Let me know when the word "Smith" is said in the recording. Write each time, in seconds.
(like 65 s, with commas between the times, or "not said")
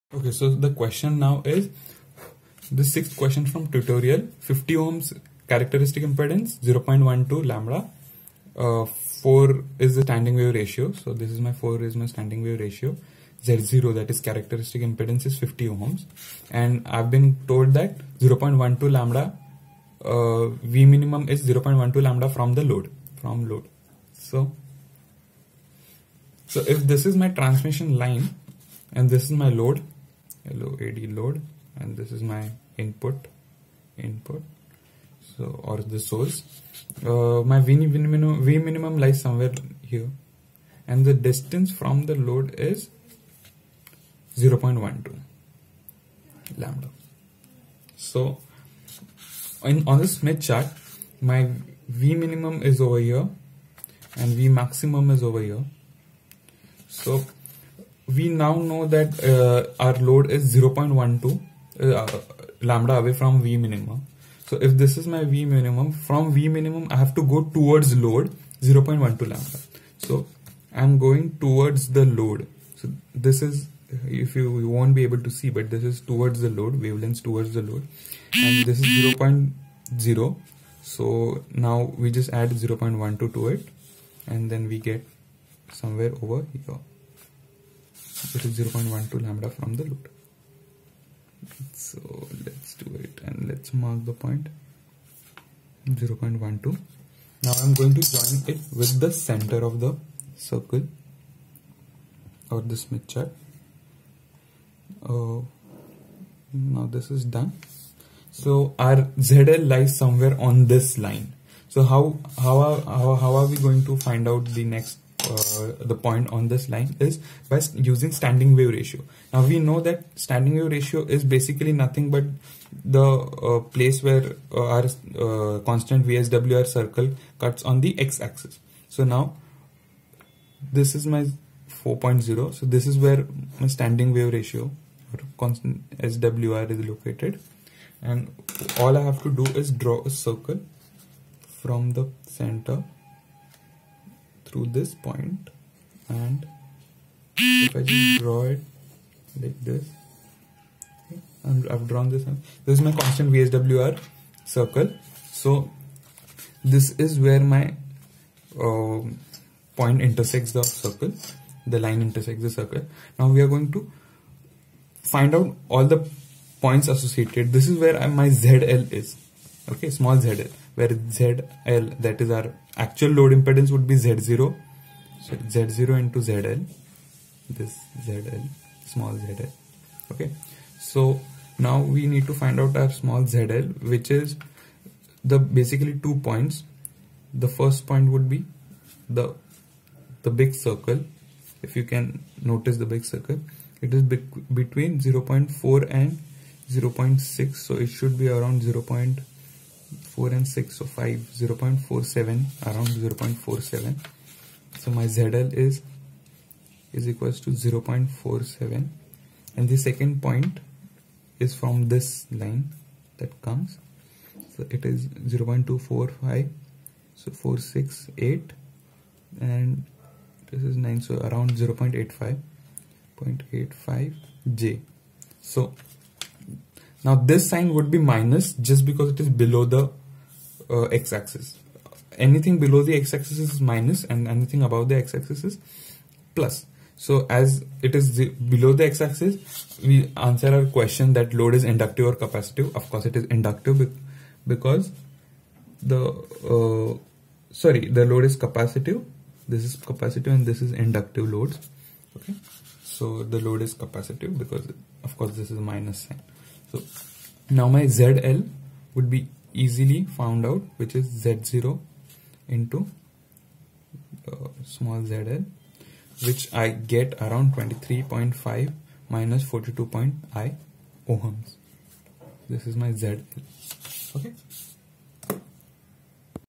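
50 s, 102 s.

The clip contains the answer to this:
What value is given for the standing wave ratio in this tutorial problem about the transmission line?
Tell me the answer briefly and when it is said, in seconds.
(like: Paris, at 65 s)
4, at 8 s.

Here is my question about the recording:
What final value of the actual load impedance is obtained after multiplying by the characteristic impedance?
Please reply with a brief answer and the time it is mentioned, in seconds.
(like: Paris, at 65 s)
23.5 - 42.5 ohms, at 267 s.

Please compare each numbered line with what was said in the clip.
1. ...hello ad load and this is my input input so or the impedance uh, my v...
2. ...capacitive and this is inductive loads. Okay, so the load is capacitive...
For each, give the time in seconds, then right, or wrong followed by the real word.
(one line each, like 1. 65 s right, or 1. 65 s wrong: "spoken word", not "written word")
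1. 30 s wrong: "source", not "impedance"
2. 249 s right.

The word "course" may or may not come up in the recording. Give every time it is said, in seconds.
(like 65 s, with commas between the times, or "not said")
242 s, 255 s.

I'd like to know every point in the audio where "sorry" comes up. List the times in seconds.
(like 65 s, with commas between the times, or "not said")
247 s.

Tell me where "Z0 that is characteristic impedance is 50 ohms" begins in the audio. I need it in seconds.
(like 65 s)
13 s.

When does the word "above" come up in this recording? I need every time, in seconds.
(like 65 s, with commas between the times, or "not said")
234 s.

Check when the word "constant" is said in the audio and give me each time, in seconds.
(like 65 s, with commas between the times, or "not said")
125 s, 135 s, 152 s.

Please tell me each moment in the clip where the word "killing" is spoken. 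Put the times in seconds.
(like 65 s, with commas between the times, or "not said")
not said.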